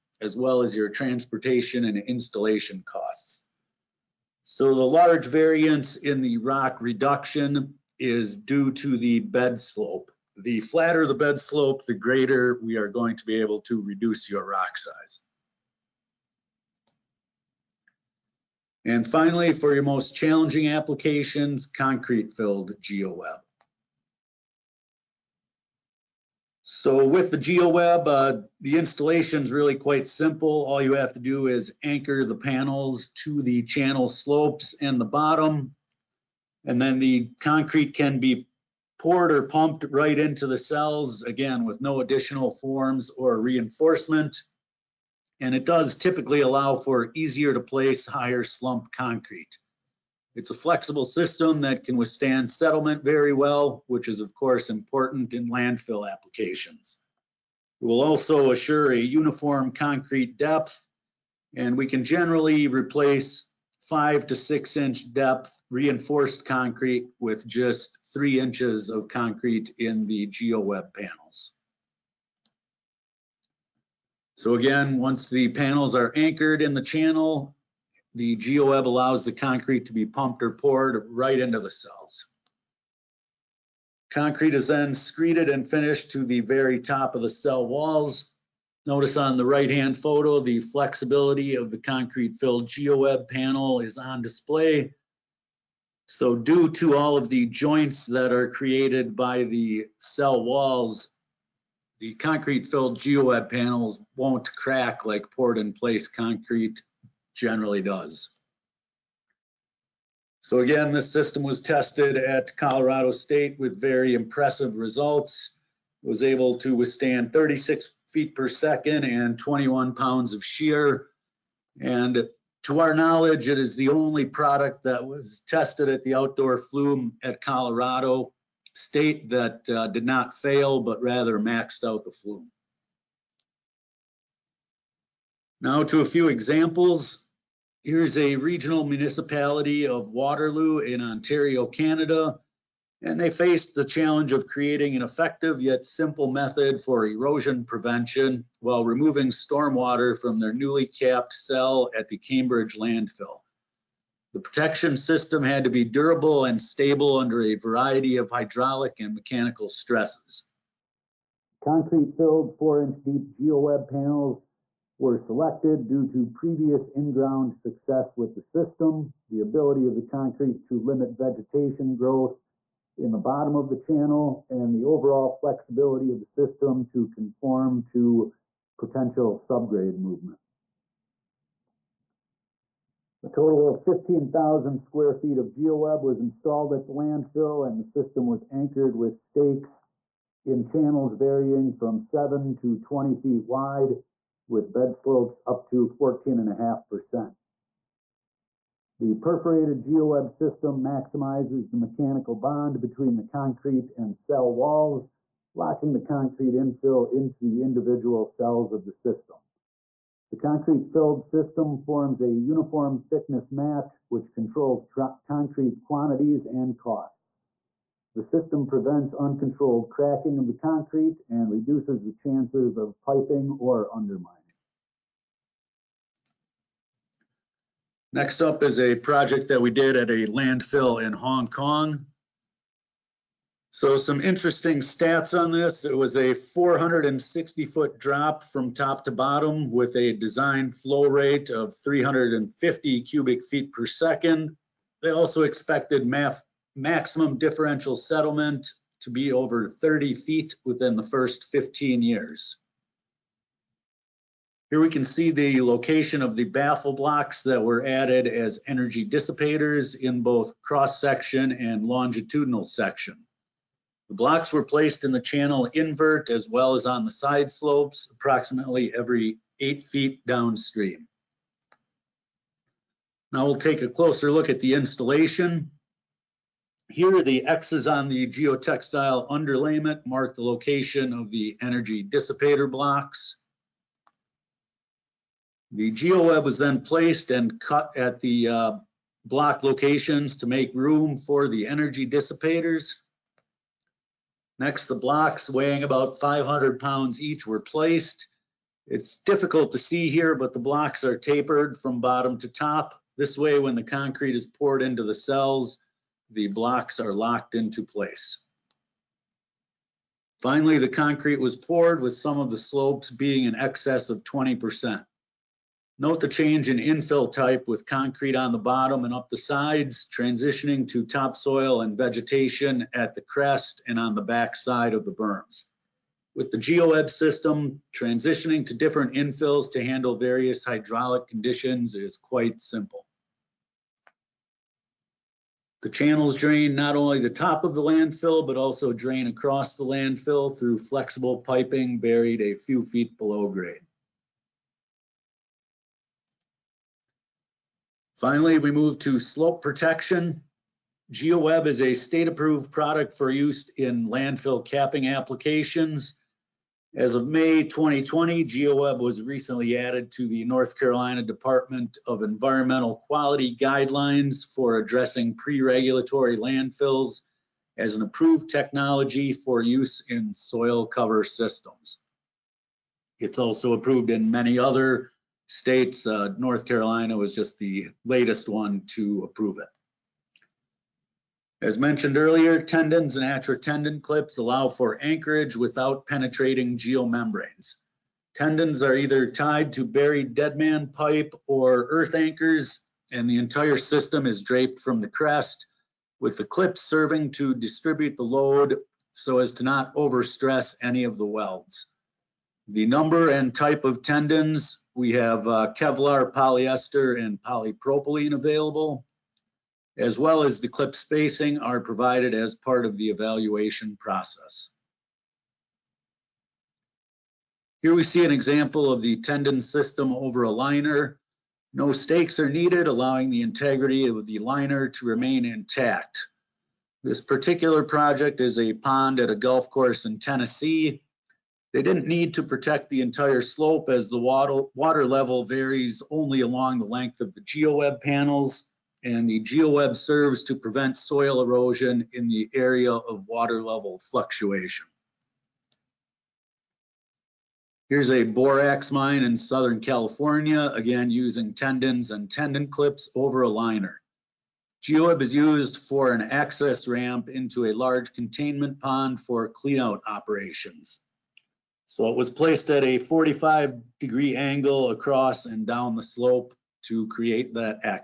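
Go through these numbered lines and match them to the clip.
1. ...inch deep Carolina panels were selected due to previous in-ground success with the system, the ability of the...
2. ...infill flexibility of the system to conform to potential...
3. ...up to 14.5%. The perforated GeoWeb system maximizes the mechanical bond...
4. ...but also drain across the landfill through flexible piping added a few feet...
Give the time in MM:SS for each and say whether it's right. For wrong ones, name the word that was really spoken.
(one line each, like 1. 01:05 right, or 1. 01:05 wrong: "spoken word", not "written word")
1. 02:42 wrong: "GeoWeb", not "Carolina"
2. 02:54 wrong: "overall", not "infill"
3. 03:15 right
4. 05:38 wrong: "buried", not "added".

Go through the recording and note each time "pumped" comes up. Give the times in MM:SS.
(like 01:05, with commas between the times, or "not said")
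00:39, 01:20.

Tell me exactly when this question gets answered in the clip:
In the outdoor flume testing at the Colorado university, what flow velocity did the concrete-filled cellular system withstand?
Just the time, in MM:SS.
01:57.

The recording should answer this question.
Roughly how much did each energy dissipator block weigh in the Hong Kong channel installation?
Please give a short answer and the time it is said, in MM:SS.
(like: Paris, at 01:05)
500 pounds, at 04:56.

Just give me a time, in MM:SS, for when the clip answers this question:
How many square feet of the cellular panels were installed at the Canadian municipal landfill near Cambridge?
03:03.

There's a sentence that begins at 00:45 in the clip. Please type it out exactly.
And it does typically allow for easier to place higher slump concrete.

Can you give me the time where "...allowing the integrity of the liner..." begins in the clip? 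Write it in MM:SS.
07:02.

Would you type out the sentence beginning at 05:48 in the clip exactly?
Finally, we move to slope protection.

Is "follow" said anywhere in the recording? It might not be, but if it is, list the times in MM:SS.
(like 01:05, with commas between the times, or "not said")
not said.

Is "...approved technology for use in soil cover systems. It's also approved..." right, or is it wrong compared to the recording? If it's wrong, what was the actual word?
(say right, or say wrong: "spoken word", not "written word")
right.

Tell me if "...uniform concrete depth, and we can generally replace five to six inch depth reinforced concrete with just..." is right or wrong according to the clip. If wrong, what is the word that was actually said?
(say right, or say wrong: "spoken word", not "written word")
right.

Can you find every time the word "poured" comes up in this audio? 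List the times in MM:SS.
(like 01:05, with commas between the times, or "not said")
00:38, 01:20, 01:45, 05:04, 05:11.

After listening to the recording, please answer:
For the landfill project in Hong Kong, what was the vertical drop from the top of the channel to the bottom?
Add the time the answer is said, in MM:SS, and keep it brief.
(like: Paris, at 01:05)
460 feet, at 03:56.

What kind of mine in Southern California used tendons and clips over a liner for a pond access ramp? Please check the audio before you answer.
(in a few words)
borax mine.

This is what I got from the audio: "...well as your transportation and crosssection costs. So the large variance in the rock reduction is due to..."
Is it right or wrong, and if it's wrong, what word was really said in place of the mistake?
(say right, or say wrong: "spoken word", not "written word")
wrong: "installation", not "crosssection".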